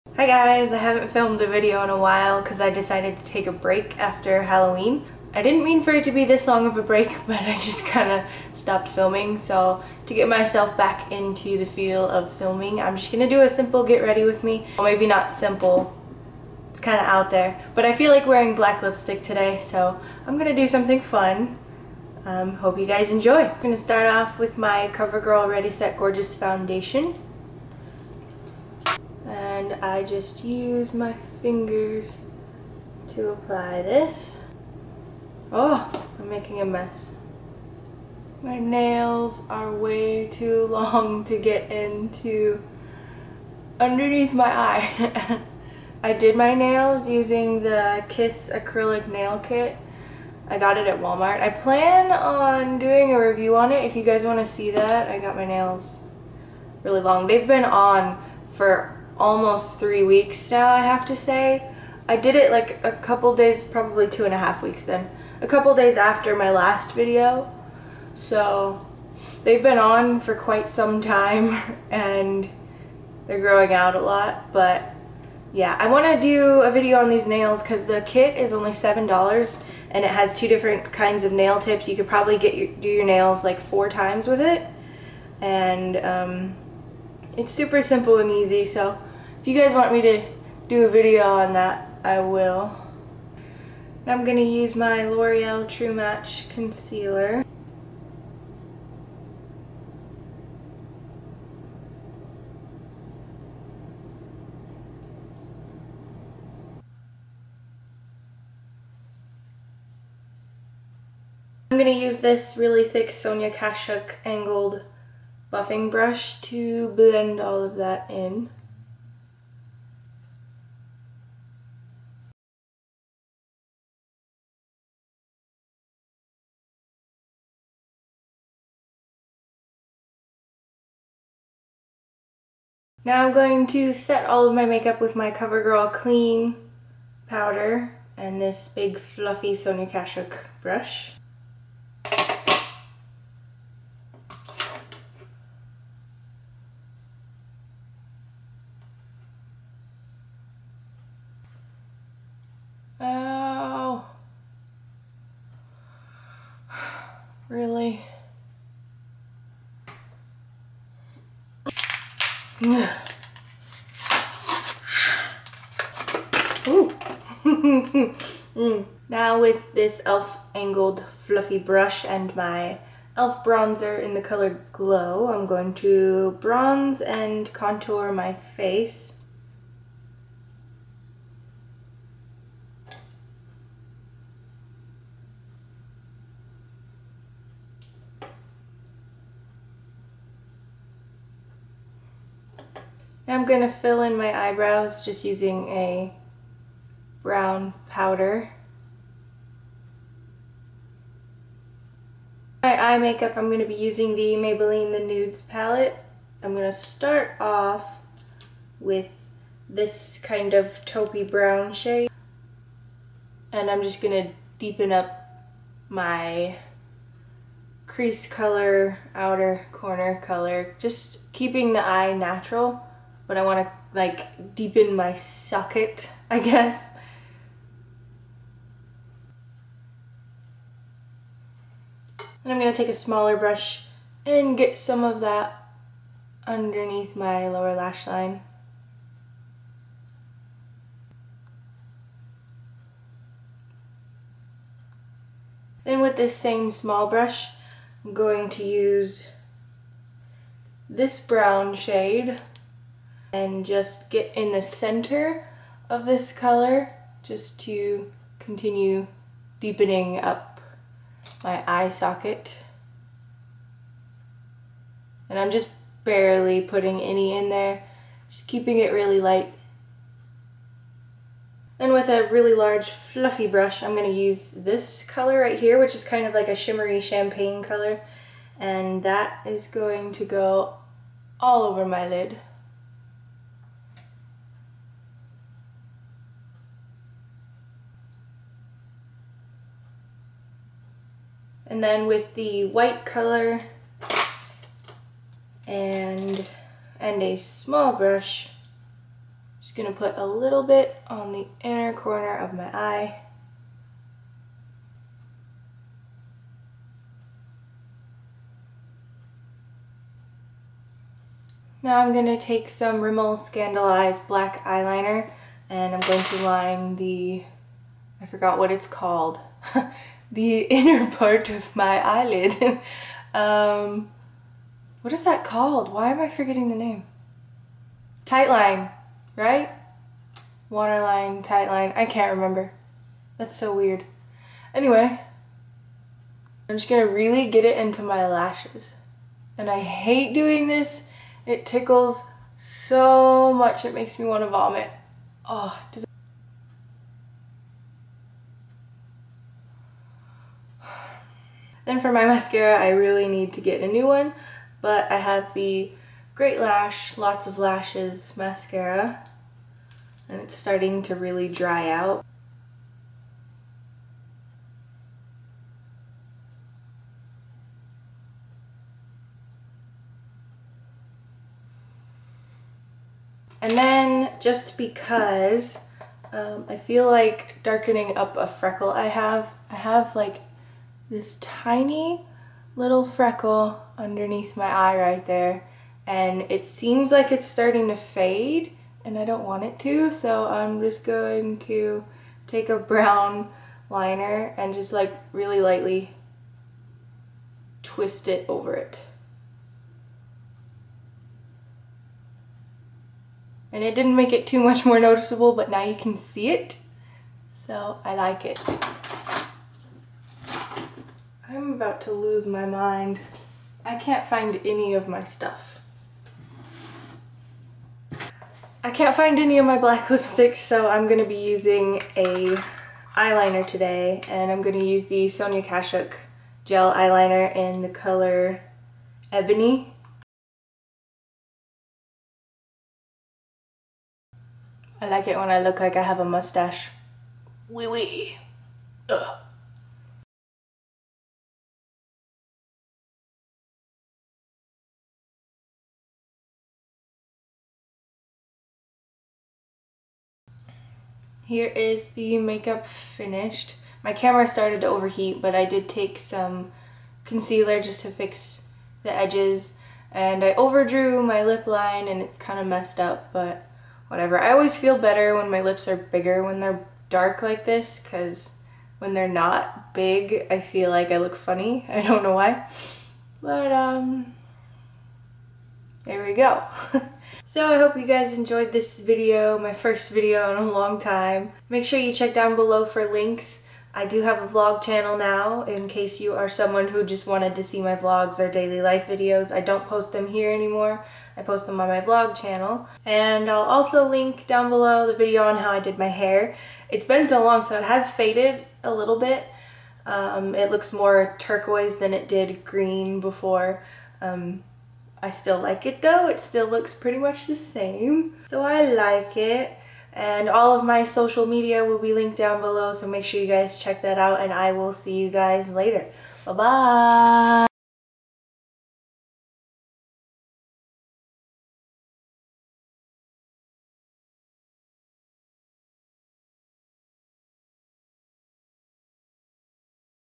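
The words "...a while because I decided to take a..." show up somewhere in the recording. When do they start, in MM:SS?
00:01.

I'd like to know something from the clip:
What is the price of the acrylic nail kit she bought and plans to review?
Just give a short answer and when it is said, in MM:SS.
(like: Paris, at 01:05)
$7, at 01:18.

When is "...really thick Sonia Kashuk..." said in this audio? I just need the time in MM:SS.
01:52.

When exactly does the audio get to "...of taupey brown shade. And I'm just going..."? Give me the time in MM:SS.
03:30.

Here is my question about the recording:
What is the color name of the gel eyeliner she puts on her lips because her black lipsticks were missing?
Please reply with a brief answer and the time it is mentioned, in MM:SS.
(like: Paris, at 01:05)
Ebony, at 07:09.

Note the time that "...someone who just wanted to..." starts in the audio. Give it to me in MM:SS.
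08:06.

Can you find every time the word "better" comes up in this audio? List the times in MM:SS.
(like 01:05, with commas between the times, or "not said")
07:44.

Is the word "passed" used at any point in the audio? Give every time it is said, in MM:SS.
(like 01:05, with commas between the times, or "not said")
not said.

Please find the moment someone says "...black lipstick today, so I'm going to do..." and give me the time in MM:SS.
00:18.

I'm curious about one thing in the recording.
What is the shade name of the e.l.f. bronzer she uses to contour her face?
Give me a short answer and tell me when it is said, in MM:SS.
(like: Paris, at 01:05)
Glow, at 02:54.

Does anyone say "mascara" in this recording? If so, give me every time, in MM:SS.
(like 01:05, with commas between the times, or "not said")
05:52, 05:58.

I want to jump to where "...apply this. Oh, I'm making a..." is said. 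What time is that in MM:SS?
00:33.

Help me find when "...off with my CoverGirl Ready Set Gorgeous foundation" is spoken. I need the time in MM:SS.
00:24.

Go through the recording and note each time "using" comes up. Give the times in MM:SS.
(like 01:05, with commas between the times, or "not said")
00:47, 03:15, 03:23, 07:01.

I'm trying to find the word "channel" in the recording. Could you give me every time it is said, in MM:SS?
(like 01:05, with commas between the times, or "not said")
08:04, 08:12.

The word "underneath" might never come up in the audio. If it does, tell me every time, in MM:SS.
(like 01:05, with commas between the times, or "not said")
00:43, 03:56, 06:23.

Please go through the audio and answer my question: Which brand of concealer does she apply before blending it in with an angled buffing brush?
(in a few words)
L'Oreal True Match.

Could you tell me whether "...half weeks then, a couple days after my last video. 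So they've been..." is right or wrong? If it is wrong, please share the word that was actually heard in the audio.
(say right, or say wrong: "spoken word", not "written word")
right.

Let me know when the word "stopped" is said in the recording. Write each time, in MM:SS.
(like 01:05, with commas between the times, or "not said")
00:08.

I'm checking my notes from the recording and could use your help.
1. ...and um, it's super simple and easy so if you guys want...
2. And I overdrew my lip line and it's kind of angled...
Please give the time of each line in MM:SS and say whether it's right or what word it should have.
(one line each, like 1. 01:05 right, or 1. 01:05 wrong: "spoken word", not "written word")
1. 01:25 right
2. 07:40 wrong: "messed", not "angled".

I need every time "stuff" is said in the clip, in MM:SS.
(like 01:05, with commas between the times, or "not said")
06:55.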